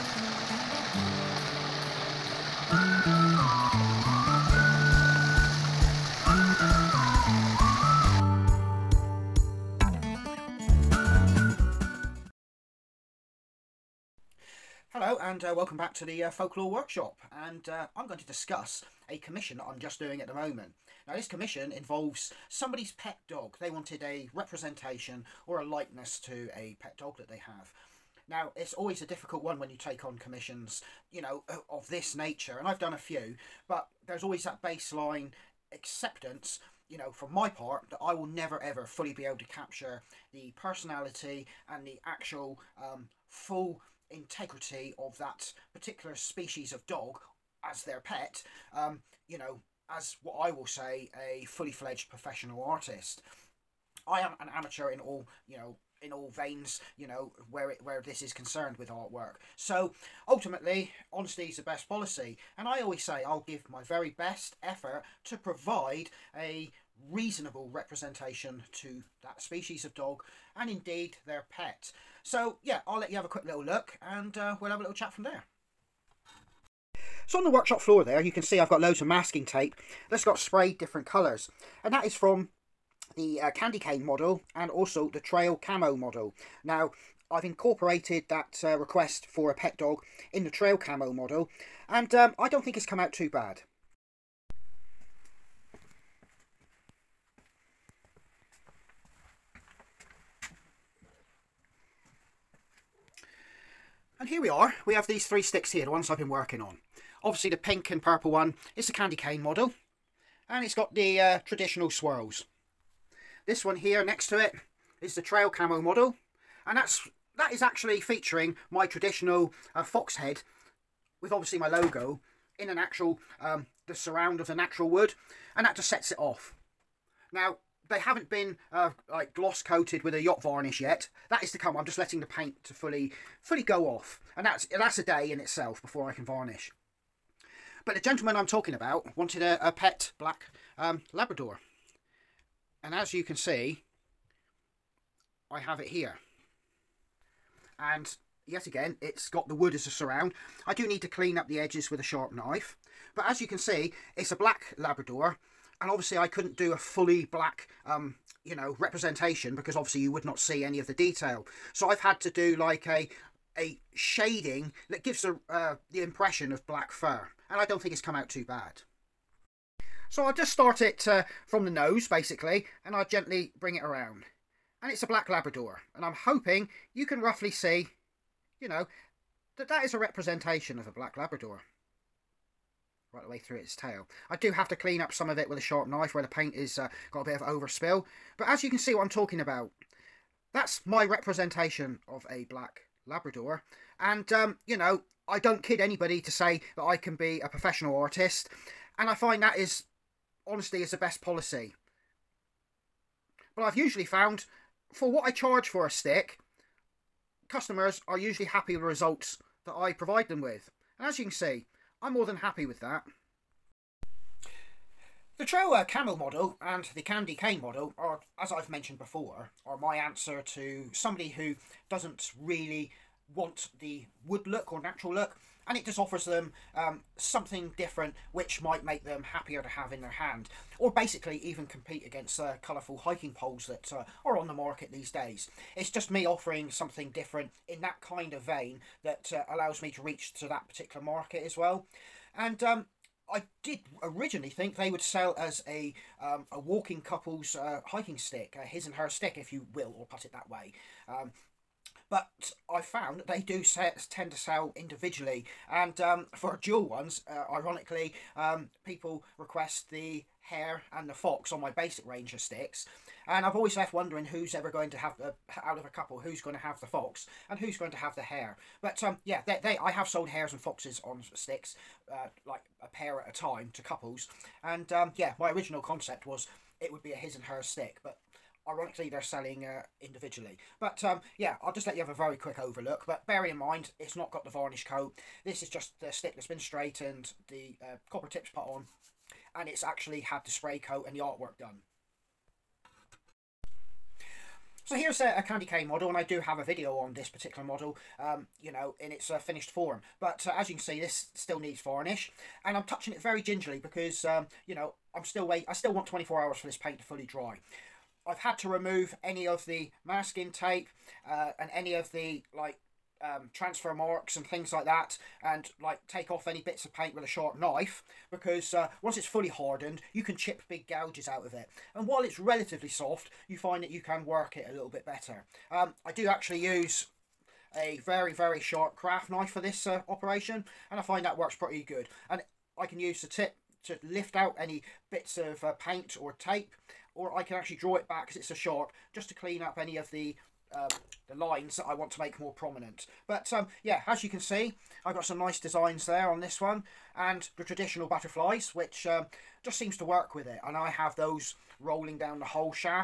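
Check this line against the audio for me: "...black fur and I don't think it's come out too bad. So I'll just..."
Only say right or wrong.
right.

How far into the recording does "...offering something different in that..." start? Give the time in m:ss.
3:56.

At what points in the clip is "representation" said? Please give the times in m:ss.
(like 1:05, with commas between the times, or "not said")
0:24, 1:07, 2:38, 2:59, 3:11.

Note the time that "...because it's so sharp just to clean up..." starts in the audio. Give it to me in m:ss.
5:38.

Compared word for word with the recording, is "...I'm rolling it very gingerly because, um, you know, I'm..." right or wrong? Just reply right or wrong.
wrong.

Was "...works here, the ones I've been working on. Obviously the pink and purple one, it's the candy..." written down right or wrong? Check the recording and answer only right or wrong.
wrong.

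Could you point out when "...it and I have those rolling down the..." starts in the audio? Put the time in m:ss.
5:50.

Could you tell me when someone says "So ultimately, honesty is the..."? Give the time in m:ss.
0:59.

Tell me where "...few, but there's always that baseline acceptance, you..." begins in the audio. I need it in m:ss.
0:32.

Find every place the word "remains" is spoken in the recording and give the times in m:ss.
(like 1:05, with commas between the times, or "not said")
not said.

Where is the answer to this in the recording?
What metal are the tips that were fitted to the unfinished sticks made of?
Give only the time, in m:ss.
4:48.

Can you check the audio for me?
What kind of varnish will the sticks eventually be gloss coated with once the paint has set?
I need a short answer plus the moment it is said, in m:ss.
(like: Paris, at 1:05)
Yacht varnish, at 2:10.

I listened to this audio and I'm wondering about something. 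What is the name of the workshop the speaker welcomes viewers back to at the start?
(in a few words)
Folklore Workshop.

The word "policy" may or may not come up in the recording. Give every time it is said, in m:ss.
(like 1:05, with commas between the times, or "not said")
1:01, 3:21.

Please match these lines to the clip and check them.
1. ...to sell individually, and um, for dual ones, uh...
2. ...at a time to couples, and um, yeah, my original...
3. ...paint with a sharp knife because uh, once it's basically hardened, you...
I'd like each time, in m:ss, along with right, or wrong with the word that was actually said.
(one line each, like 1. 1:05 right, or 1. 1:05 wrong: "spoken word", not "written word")
1. 4:14 right
2. 4:33 right
3. 5:16 wrong: "fully", not "basically".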